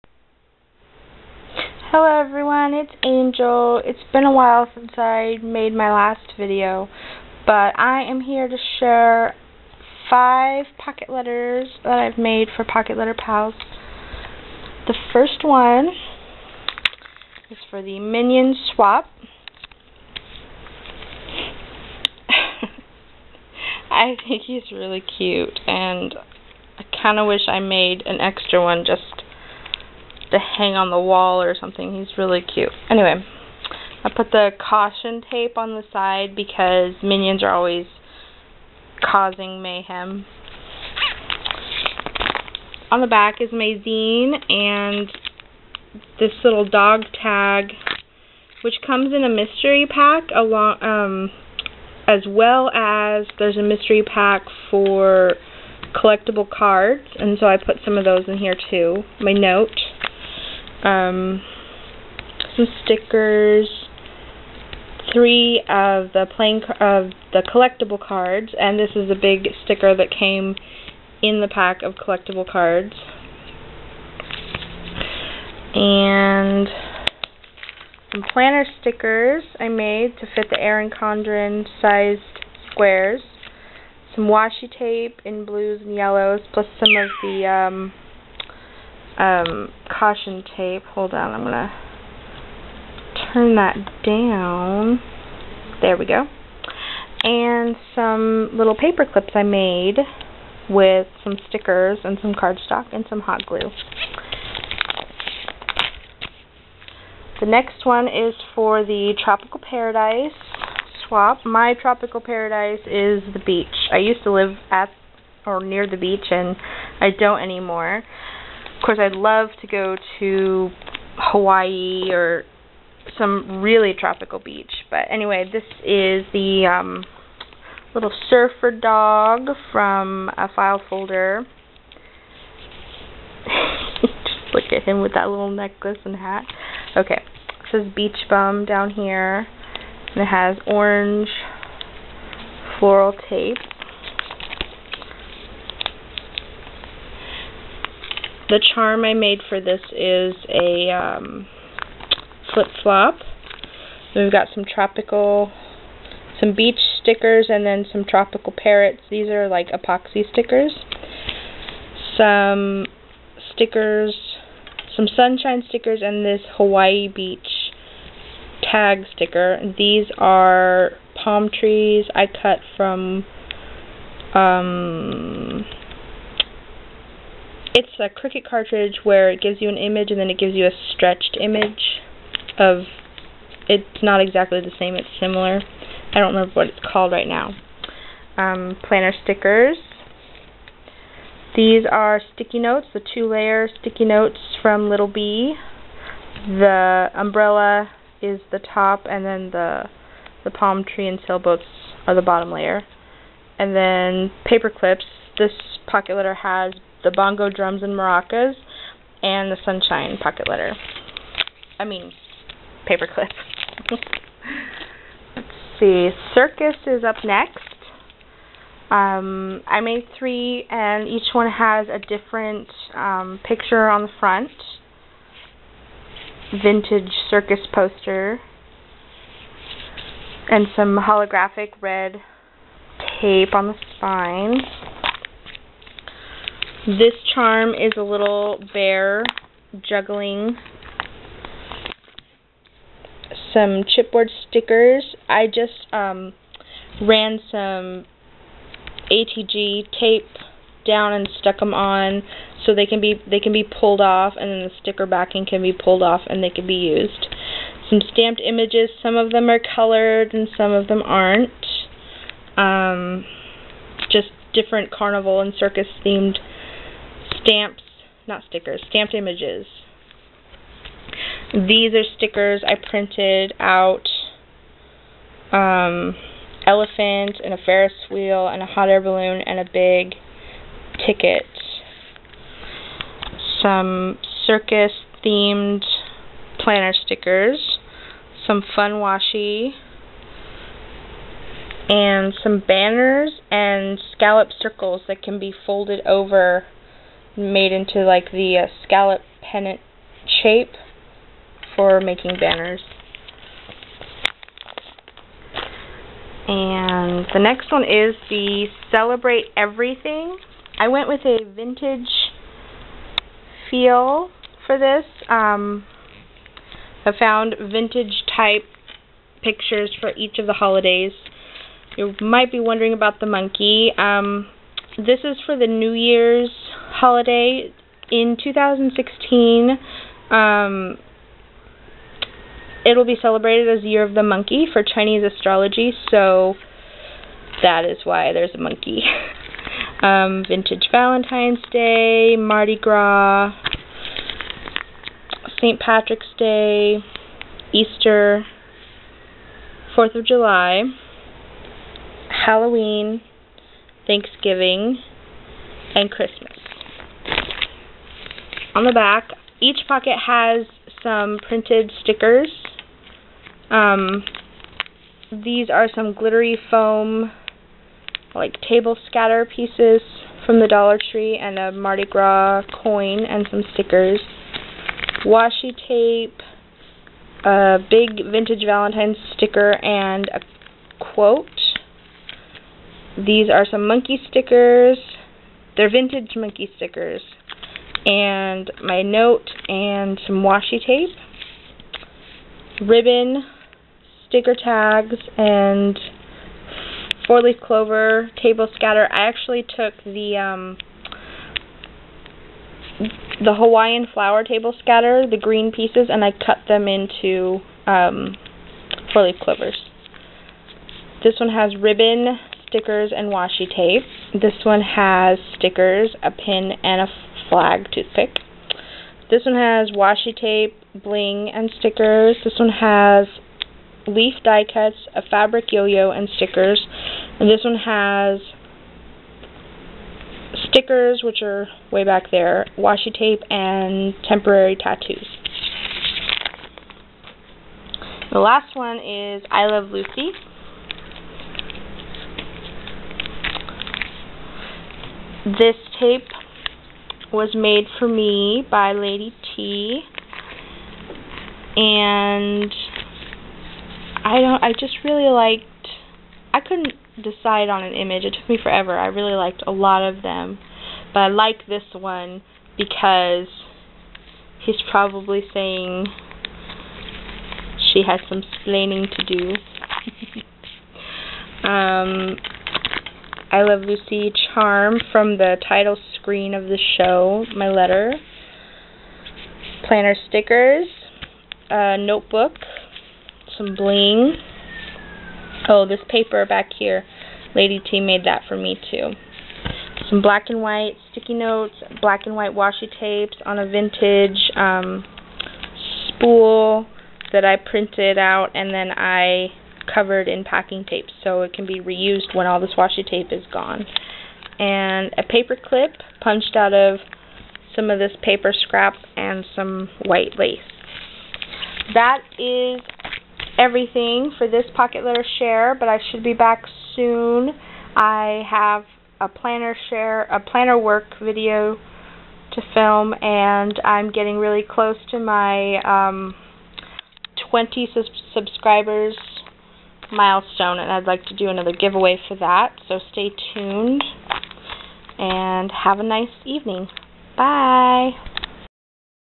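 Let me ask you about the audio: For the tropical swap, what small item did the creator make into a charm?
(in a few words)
flip-flop.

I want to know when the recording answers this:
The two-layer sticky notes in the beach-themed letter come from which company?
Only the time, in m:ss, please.
3:14.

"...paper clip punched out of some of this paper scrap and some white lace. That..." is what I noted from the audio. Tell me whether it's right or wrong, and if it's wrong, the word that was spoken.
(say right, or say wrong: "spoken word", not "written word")
right.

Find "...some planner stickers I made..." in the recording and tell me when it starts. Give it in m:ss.
1:18.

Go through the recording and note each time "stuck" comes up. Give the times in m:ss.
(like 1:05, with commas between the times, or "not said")
4:11.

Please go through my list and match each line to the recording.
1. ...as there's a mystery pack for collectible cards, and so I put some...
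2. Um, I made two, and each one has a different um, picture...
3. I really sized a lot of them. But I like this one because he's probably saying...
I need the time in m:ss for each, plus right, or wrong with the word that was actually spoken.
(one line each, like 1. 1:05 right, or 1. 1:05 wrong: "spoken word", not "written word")
1. 0:52 right
2. 3:38 wrong: "three", not "two"
3. 7:38 wrong: "liked", not "sized".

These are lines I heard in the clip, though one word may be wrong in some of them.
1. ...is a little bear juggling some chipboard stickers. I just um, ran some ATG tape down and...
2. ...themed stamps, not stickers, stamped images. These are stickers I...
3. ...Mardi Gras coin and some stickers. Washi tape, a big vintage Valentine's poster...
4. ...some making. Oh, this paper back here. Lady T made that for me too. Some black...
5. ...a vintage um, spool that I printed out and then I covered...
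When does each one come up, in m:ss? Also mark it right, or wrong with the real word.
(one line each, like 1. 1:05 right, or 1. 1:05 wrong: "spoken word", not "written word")
1. 3:57 right
2. 4:26 right
3. 6:11 wrong: "sticker", not "poster"
4. 8:03 wrong: "bling", not "making"
5. 8:13 right.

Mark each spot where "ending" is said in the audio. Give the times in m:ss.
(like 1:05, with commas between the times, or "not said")
not said.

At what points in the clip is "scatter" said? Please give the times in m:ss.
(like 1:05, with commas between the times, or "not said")
6:09, 6:38, 6:44.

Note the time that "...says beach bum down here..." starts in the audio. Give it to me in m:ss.
2:17.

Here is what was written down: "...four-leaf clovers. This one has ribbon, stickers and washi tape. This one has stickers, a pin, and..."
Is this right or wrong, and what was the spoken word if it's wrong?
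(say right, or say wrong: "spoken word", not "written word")
right.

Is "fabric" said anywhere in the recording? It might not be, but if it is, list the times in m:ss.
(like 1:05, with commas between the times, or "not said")
7:05.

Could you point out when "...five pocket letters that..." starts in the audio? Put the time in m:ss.
0:10.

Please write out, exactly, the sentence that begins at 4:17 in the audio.
Some stamped images, some of them are colored and some of them aren't.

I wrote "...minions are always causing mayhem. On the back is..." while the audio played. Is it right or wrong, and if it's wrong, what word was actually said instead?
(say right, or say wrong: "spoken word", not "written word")
right.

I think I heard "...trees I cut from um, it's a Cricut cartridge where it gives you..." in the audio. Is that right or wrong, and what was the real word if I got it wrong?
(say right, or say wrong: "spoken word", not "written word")
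right.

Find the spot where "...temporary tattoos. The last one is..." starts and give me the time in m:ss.
7:14.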